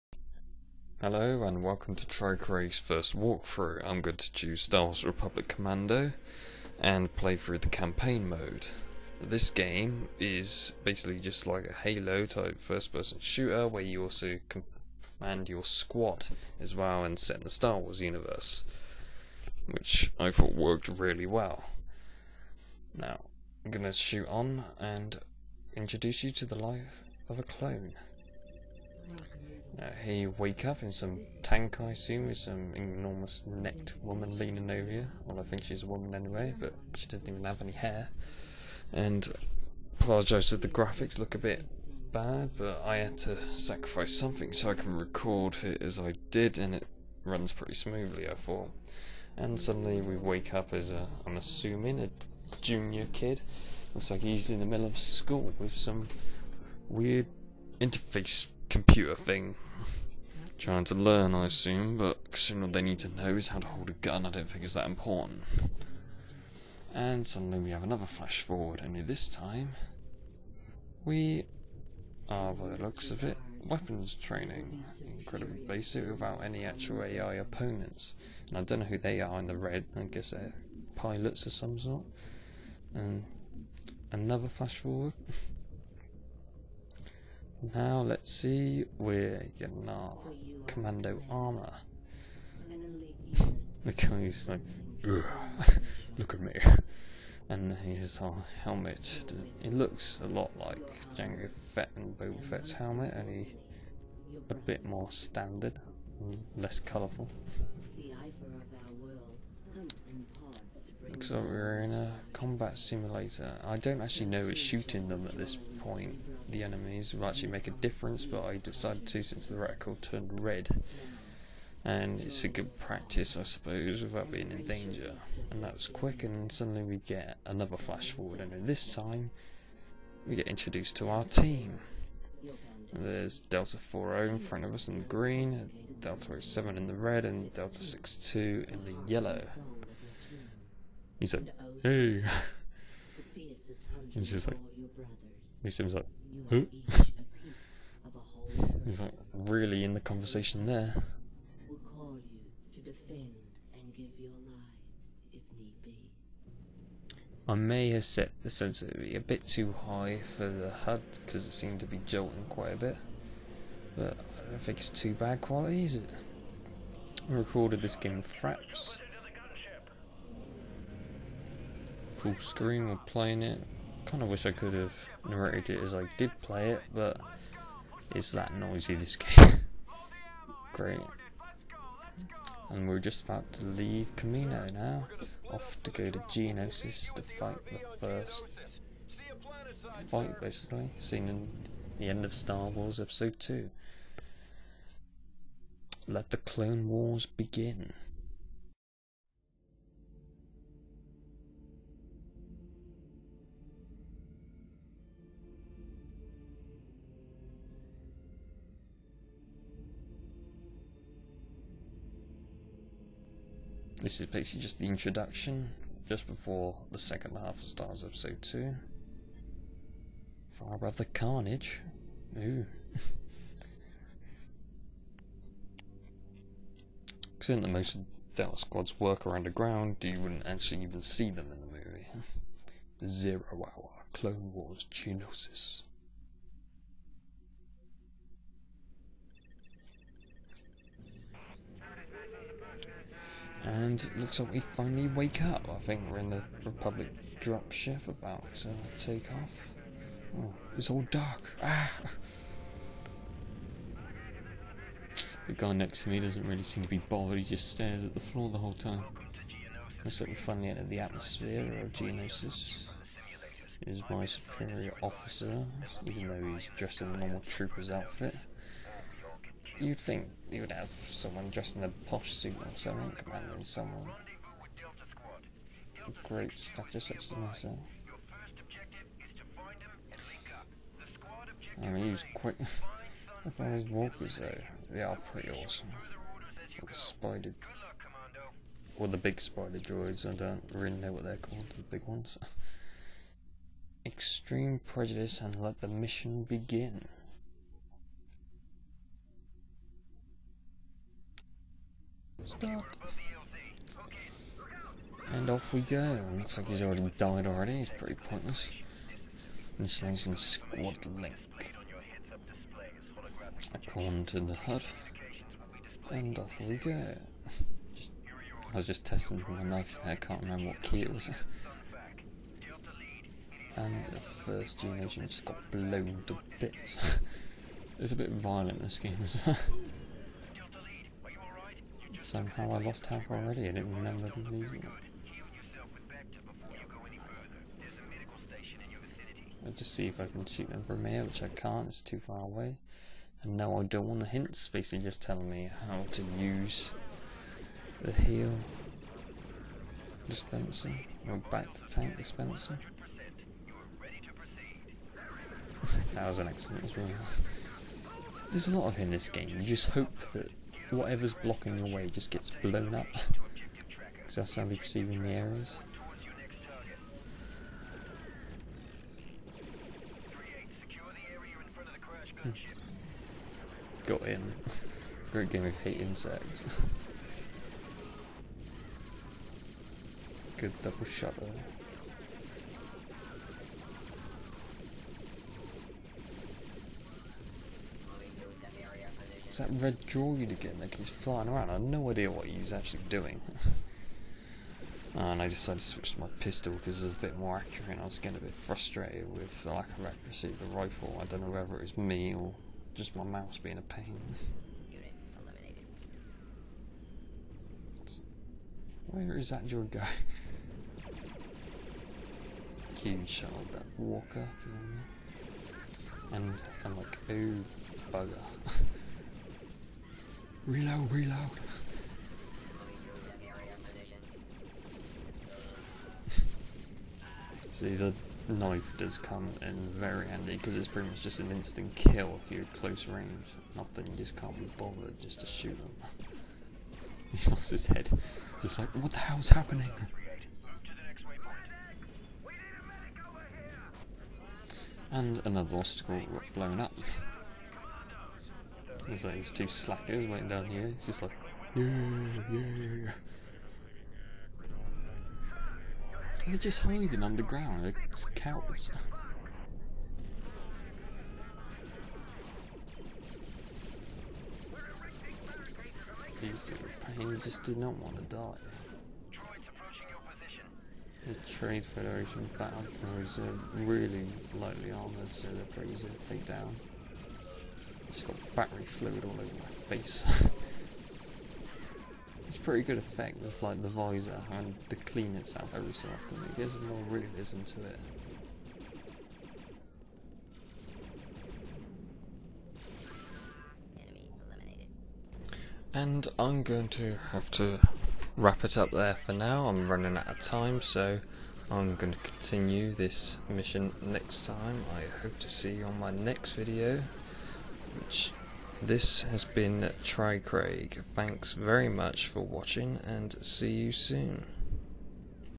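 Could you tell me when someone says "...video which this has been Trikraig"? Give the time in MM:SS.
08:26.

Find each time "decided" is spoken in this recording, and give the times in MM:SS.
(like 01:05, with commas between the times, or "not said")
01:58, 06:35.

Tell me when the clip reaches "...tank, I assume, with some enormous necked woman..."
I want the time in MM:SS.
00:31.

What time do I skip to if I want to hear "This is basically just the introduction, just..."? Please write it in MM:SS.
03:34.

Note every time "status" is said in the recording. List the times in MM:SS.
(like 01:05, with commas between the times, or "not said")
04:36.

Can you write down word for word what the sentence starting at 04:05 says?
I think we're in the Republic drop ship about to take off.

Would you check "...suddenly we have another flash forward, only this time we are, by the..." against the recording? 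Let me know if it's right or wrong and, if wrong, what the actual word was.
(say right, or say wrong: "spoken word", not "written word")
right.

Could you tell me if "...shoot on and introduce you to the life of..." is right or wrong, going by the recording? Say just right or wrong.
right.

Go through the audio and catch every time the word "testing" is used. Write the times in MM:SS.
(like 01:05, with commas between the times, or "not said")
05:19.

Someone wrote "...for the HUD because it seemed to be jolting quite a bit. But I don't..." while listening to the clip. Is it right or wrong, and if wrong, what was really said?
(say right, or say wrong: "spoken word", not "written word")
right.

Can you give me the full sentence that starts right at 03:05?
Off to go to Geonosis to fight the first fight, basically, seen in the end of Star Wars Episode 2.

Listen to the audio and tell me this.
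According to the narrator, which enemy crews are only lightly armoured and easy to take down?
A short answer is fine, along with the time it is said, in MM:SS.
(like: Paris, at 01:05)
Trade Federation battle crews, at 07:51.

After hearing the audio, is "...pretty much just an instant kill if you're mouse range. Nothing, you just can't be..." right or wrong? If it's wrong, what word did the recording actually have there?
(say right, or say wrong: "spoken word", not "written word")
wrong: "close", not "mouse".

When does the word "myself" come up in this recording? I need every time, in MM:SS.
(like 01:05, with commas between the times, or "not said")
04:37.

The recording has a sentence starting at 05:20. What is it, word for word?
I can't remember what key it was.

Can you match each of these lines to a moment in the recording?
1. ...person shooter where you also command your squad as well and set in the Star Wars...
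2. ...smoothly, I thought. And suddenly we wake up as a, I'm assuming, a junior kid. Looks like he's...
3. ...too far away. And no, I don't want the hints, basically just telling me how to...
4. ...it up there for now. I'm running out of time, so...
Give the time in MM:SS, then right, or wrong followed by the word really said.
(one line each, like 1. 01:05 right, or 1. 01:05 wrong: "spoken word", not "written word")
1. 00:12 right
2. 00:47 right
3. 05:42 right
4. 08:18 right.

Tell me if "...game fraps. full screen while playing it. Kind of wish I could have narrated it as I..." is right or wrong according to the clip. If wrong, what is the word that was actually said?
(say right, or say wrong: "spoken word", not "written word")
right.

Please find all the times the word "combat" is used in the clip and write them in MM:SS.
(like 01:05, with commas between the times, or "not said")
01:52.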